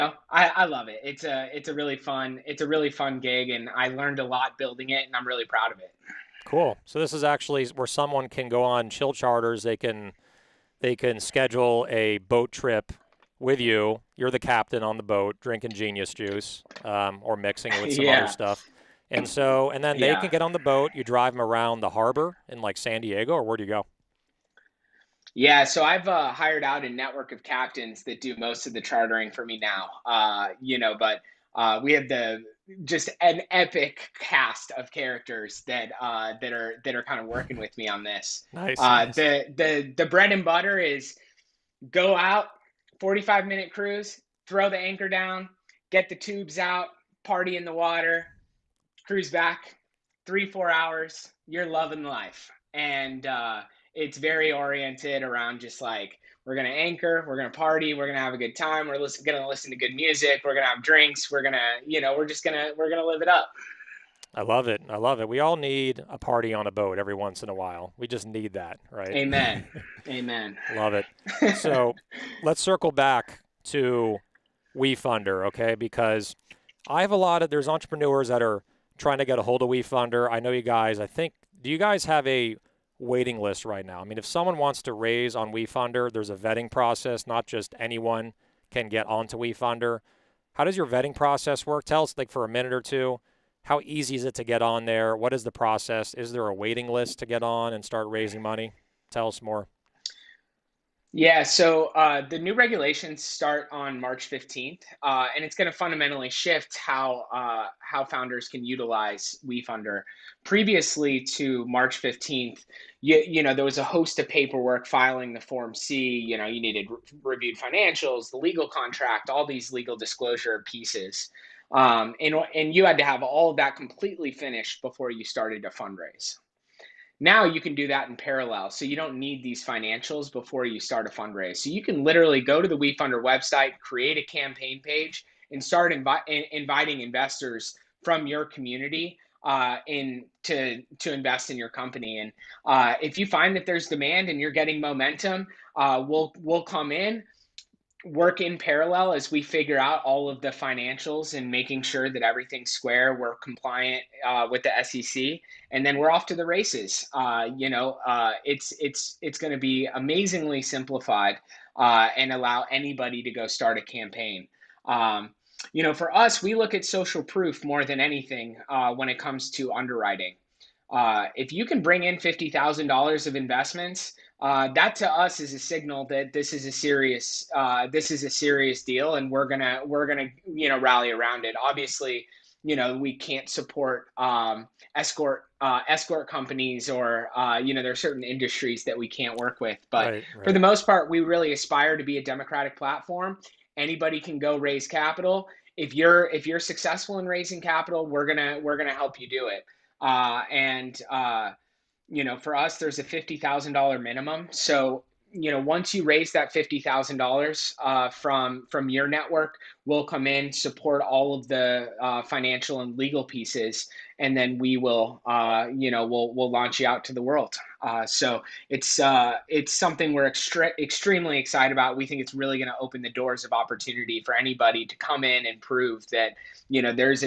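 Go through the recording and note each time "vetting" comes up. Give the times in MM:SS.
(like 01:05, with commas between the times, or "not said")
01:26, 01:30.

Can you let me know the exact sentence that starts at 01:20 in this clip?
I know you guys, I think do you guys have a waiting list right now?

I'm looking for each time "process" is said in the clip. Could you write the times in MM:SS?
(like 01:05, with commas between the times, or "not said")
01:26, 01:31, 01:35.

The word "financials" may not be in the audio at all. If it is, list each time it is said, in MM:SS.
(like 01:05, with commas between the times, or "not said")
01:57, 02:09, 02:30, 03:32.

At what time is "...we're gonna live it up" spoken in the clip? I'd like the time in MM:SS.
01:02.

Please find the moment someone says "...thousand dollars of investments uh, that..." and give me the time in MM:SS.
02:52.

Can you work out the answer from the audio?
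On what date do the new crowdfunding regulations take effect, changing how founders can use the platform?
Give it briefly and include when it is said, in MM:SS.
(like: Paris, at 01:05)
March 15th, at 01:43.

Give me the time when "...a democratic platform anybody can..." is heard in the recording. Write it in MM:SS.
03:12.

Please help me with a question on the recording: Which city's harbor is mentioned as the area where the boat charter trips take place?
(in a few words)
San Diego.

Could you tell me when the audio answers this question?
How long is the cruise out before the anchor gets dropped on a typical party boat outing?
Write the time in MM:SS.
00:42.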